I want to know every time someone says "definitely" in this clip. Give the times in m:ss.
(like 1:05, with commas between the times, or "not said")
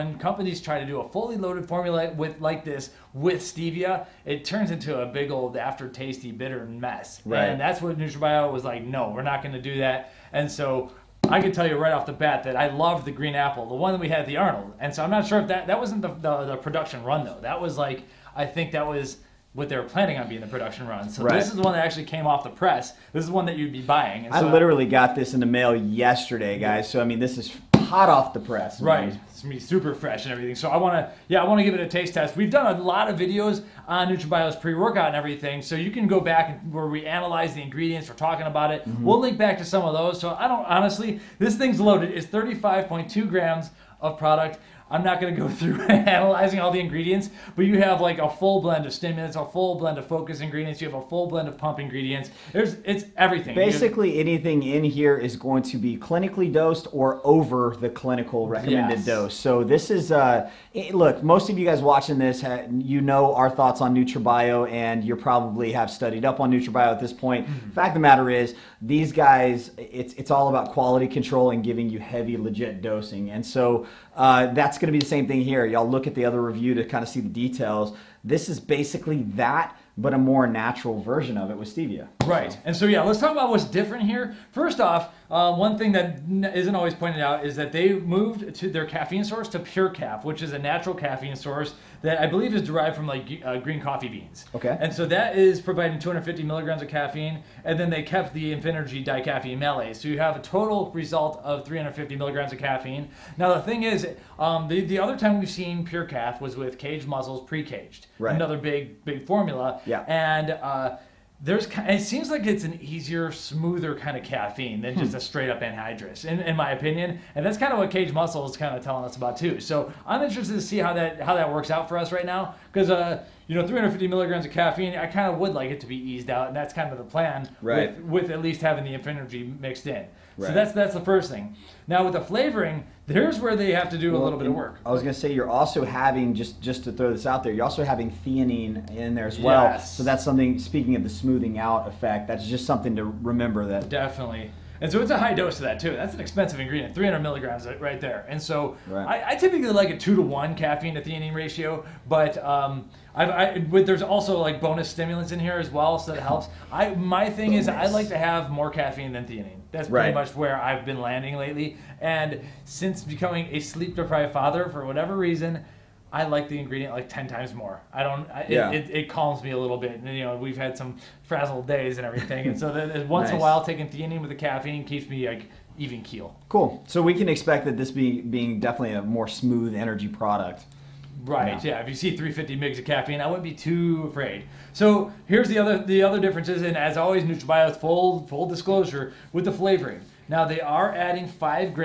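2:23, 2:58.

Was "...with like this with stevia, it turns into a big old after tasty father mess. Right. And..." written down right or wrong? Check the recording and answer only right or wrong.
wrong.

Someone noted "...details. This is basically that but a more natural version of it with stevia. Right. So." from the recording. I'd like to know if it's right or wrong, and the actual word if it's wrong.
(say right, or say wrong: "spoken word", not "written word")
right.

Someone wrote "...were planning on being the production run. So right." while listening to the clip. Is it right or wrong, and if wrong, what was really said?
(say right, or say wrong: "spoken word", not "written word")
right.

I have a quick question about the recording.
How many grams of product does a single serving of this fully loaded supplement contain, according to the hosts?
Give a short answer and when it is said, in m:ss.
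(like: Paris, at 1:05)
35.2 grams, at 0:42.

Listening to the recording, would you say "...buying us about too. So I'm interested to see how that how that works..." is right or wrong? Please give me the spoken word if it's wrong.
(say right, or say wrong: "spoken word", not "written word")
wrong: "telling", not "buying".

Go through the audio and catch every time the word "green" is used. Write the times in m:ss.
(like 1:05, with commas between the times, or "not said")
0:13, 1:33.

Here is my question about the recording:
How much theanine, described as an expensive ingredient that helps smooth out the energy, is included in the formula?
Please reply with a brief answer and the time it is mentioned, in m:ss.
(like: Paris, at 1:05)
300 milligrams, at 2:26.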